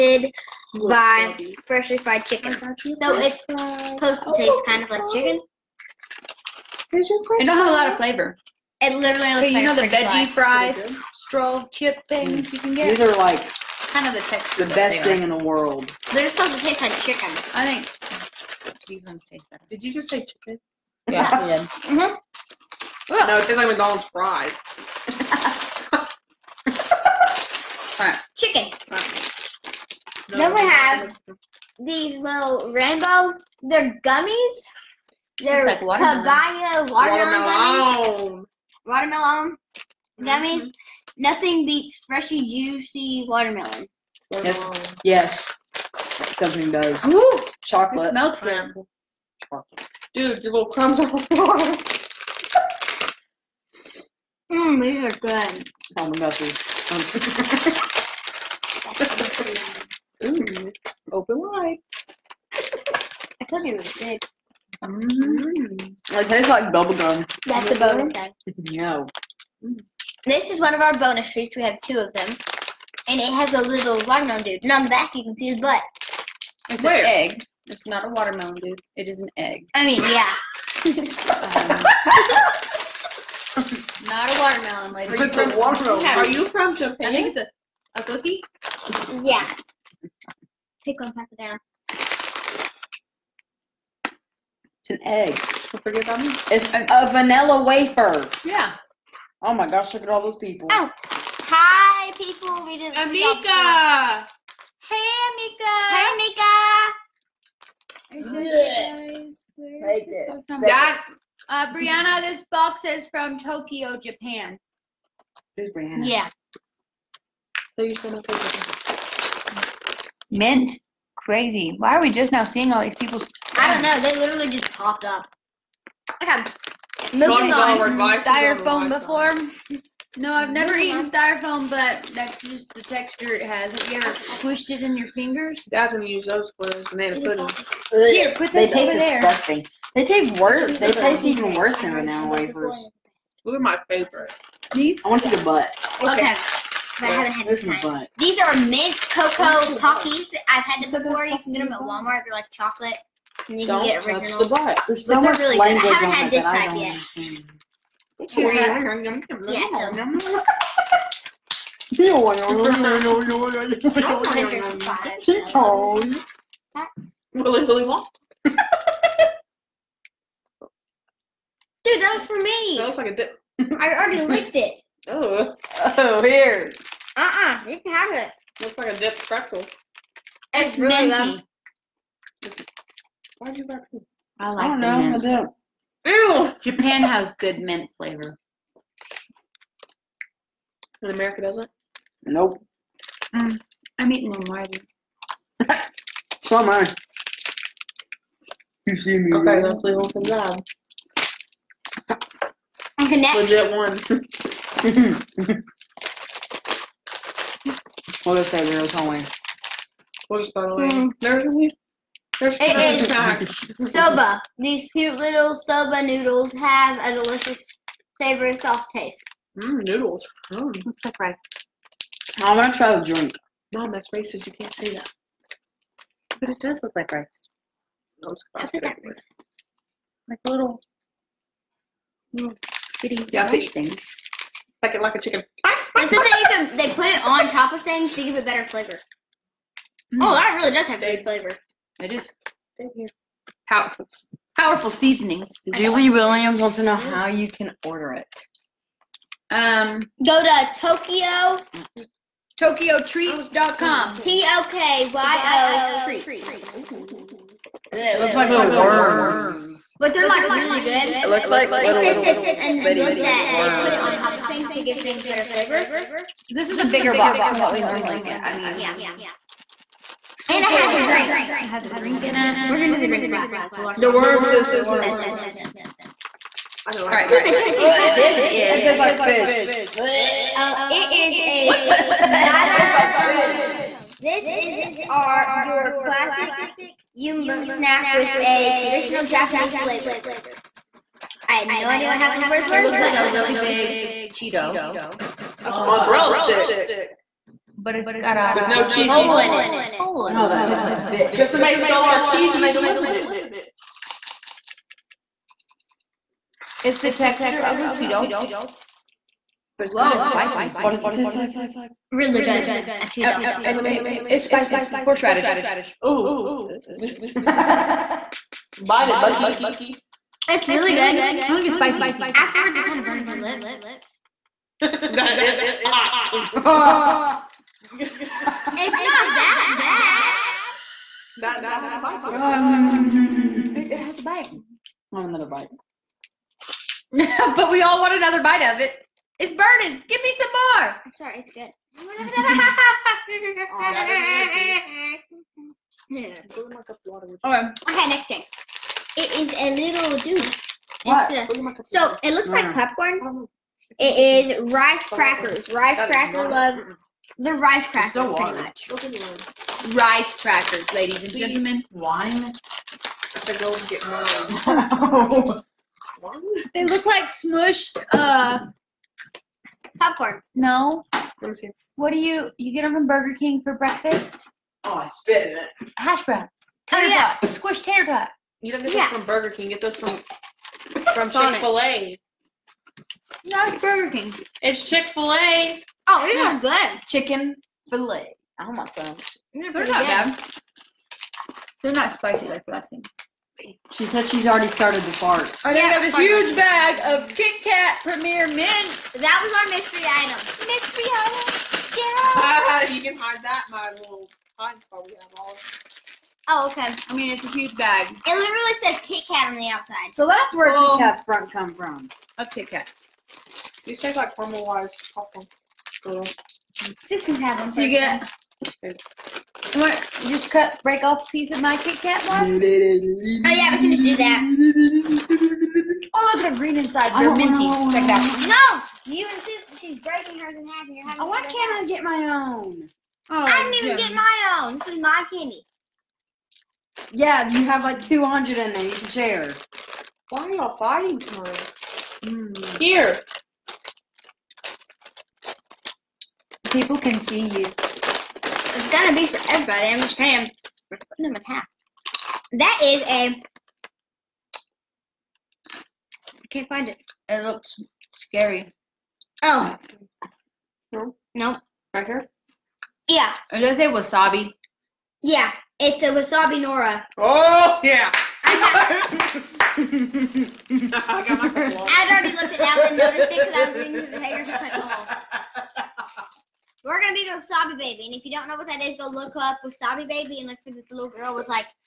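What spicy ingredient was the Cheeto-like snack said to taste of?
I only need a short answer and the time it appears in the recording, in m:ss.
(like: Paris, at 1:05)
Horseradish, at 5:15.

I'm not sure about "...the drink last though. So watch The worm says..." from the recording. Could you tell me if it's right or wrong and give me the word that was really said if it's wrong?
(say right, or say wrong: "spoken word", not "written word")
right.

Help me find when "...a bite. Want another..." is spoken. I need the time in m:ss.
5:34.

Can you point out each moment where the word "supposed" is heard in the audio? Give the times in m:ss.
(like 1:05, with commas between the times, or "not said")
0:03, 0:16.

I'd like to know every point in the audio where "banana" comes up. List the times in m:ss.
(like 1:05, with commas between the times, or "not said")
2:16, 2:21.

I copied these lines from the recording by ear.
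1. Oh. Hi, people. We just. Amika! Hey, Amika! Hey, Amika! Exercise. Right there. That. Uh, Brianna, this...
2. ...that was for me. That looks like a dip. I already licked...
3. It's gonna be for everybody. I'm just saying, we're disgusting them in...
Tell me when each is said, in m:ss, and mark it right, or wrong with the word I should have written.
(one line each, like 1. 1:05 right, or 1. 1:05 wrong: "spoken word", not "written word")
1. 1:40 right
2. 2:52 right
3. 7:27 wrong: "putting", not "disgusting".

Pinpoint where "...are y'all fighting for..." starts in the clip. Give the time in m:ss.
7:20.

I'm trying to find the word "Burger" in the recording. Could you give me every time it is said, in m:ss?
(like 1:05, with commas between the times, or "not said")
6:13, 6:19, 6:23.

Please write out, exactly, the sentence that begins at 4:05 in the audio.
Julie Williams wants to know how you can order it.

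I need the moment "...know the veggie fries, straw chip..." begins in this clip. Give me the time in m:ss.
0:09.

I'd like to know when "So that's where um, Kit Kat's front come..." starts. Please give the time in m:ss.
6:50.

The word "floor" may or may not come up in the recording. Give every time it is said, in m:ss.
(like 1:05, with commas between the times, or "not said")
0:51.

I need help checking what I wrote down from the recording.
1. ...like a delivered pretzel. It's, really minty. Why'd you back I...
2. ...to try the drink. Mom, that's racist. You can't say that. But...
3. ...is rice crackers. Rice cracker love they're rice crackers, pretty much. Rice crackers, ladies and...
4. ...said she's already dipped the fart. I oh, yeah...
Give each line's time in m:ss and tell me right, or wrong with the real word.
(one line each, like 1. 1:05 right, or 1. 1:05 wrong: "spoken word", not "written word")
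1. 2:58 wrong: "dipped", not "delivered"
2. 3:42 right
3. 5:54 right
4. 6:34 wrong: "started", not "dipped".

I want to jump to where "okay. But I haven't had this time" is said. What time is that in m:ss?
2:26.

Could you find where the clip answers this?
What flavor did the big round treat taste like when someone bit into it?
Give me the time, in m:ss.
1:06.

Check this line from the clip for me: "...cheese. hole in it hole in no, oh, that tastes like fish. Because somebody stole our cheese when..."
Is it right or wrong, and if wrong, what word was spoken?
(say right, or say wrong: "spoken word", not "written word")
right.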